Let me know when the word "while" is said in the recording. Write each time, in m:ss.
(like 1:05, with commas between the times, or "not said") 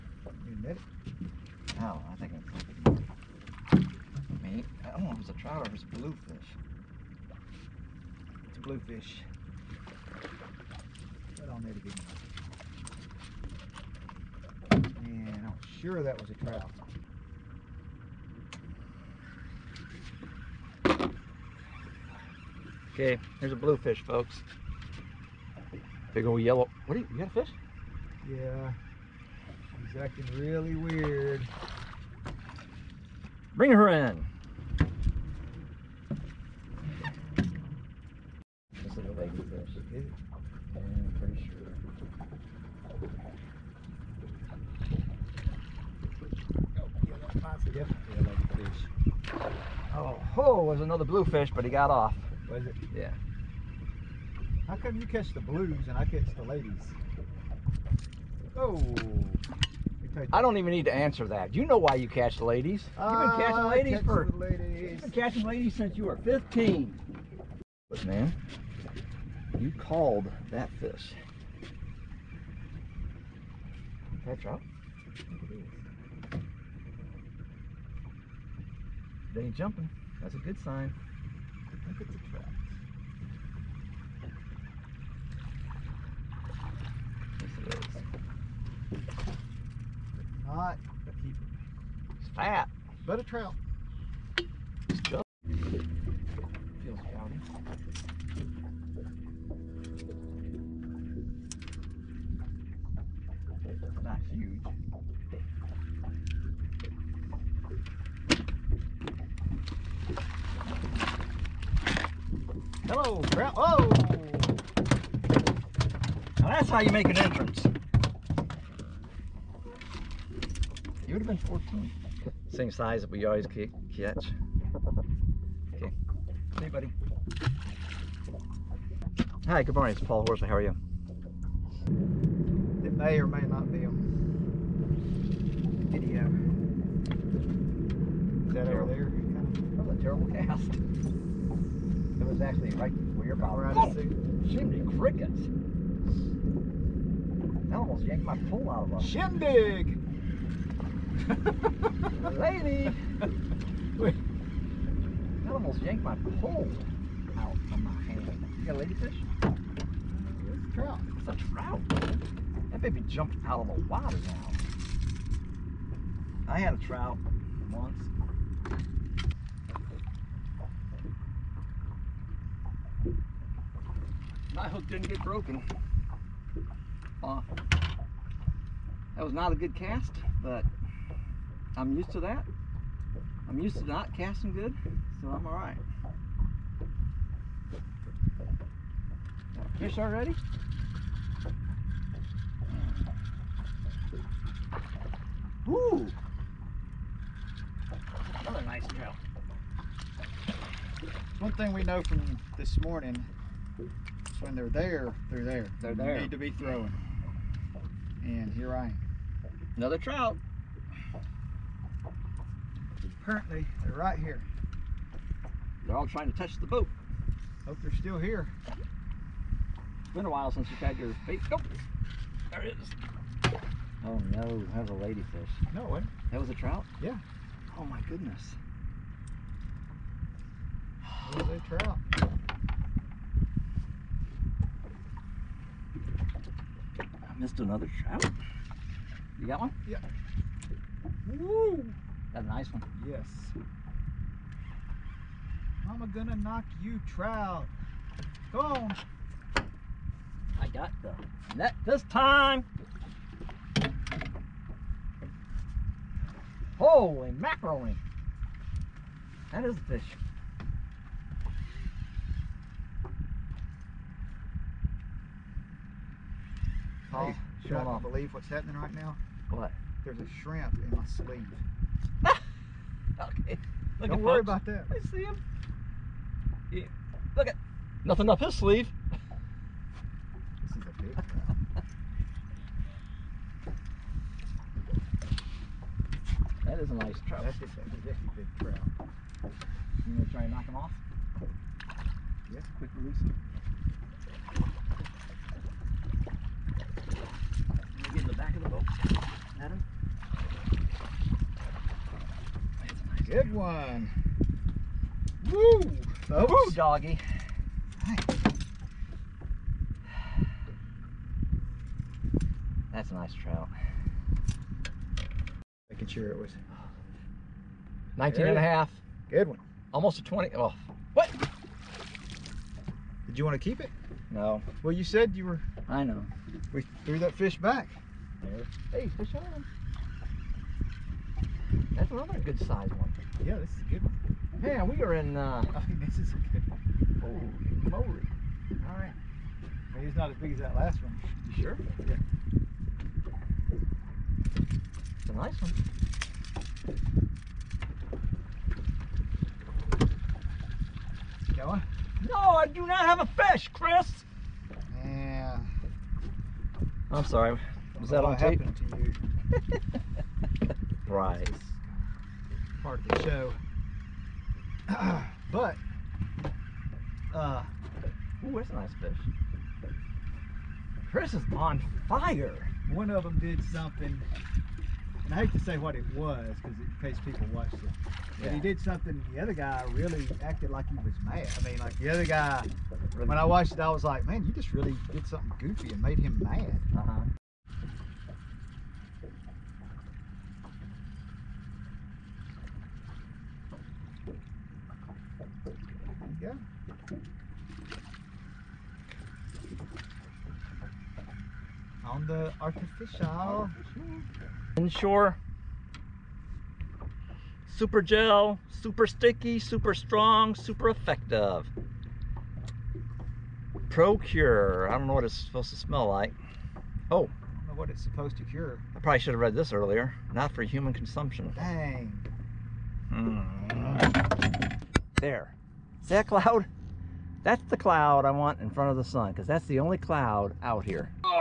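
3:40.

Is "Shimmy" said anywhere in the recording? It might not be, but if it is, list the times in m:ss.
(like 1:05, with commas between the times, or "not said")
2:24.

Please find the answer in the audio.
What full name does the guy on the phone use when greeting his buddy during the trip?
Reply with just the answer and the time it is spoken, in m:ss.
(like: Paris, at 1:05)
Paul Horsley, at 2:10.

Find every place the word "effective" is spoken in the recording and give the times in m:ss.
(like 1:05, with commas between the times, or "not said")
6:50.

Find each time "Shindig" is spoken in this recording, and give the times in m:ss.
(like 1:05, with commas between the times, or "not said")
2:29.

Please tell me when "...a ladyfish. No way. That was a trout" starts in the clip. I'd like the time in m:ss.
3:44.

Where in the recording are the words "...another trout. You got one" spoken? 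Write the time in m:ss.
3:57.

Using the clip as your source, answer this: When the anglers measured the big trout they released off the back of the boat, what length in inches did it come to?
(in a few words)
19.5.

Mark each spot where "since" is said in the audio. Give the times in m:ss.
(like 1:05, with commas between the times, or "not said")
1:05, 3:40.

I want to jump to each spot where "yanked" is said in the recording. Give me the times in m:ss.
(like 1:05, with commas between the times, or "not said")
2:28, 2:35.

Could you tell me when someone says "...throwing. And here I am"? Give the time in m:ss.
3:26.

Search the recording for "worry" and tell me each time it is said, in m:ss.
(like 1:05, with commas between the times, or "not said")
4:34.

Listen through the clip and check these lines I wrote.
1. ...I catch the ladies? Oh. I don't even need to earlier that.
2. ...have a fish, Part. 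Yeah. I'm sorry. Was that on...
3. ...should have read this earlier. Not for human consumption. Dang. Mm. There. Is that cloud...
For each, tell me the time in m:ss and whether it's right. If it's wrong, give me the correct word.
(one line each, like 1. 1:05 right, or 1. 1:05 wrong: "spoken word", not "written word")
1. 0:55 wrong: "answer", not "earlier"
2. 5:53 wrong: "Chris", not "Part"
3. 6:59 right.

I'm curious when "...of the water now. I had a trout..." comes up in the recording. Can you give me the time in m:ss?
2:43.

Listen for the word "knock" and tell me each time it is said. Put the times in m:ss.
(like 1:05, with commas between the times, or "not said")
4:06, 4:50.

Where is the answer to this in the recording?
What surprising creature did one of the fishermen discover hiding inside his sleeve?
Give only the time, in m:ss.
4:30.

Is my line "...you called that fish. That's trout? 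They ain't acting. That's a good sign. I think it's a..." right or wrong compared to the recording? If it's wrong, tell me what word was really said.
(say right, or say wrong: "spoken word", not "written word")
wrong: "jumping", not "acting".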